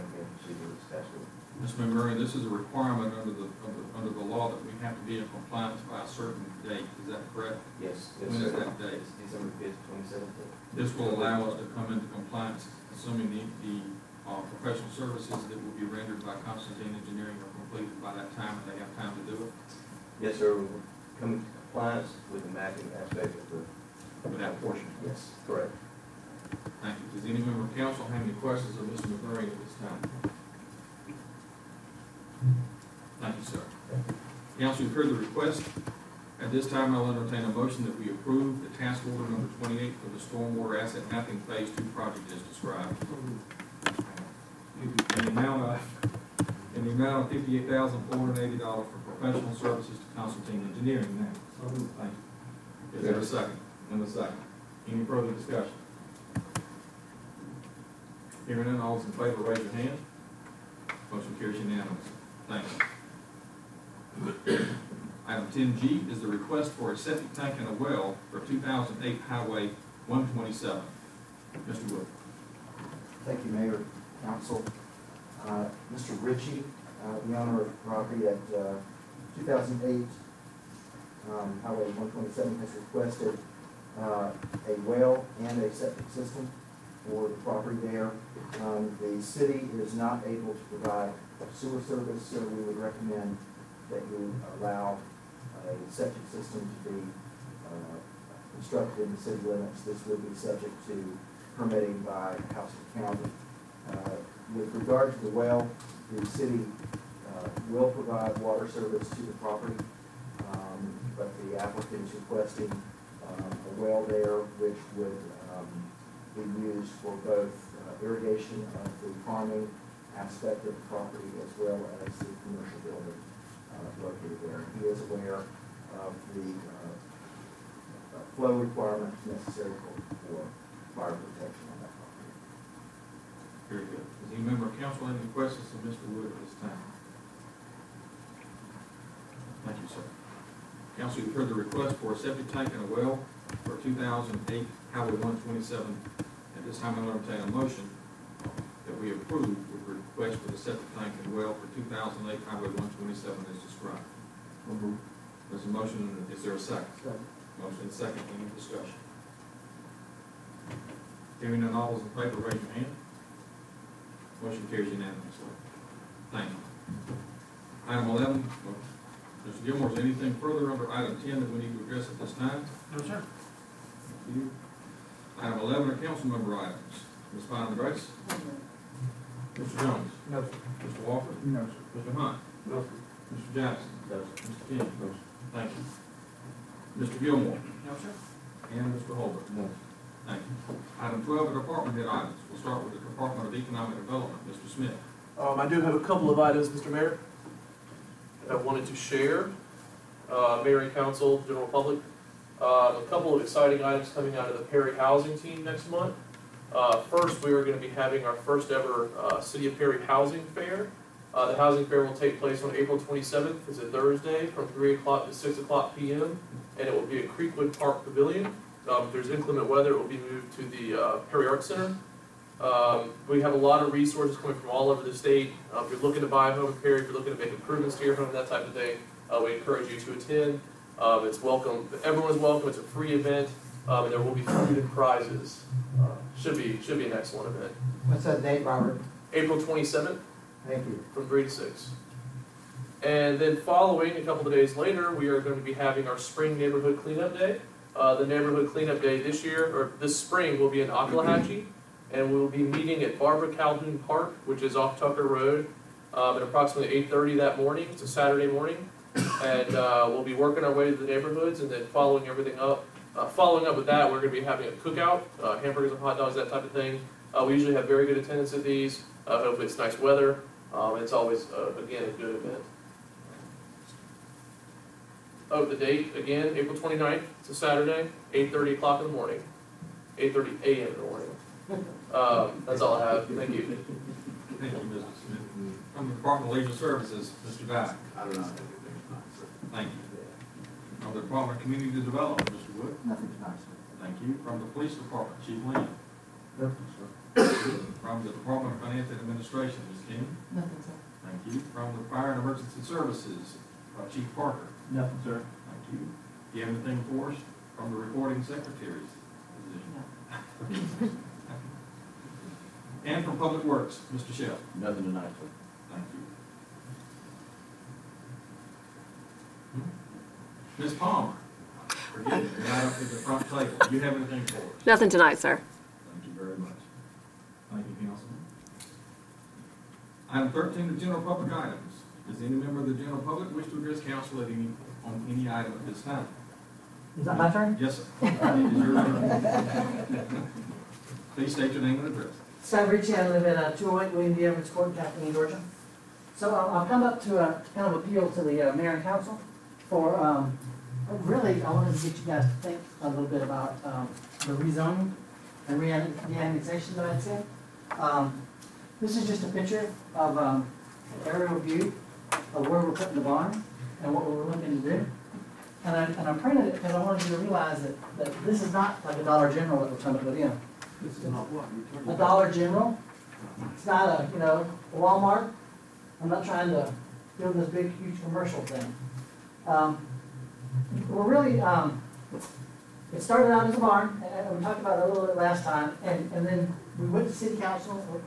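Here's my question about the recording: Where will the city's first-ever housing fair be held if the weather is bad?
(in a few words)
Perry Art Center.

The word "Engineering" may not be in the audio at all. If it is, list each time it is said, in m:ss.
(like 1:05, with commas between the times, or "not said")
0:16, 0:50.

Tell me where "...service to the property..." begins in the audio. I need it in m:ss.
1:48.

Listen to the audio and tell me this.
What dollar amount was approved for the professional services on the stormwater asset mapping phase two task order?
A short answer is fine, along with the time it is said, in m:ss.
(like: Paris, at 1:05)
$58,480, at 0:47.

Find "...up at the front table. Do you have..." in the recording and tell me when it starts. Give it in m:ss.
5:22.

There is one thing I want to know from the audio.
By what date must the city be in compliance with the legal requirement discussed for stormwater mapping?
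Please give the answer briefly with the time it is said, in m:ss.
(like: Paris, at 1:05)
December 5, 2017, at 0:09.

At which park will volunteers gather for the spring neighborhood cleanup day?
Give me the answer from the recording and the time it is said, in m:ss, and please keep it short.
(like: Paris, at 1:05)
Barbara Calhoun Park, at 4:13.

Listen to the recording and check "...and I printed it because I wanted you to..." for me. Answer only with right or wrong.
right.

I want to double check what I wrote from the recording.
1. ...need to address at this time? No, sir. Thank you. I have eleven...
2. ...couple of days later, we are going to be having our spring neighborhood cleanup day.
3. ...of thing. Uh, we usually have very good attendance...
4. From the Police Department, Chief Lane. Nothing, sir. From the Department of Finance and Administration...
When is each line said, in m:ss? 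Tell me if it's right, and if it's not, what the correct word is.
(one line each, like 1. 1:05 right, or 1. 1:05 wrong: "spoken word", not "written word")
1. 2:51 right
2. 4:04 right
3. 4:26 right
4. 4:54 right.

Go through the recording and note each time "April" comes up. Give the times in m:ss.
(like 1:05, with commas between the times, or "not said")
3:32, 3:59, 4:36.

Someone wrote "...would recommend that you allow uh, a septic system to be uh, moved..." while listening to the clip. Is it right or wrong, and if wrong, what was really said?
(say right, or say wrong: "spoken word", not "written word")
wrong: "constructed", not "moved".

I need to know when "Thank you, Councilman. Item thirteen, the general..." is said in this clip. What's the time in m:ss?
5:27.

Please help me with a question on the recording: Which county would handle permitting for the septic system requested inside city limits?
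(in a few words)
Houston County.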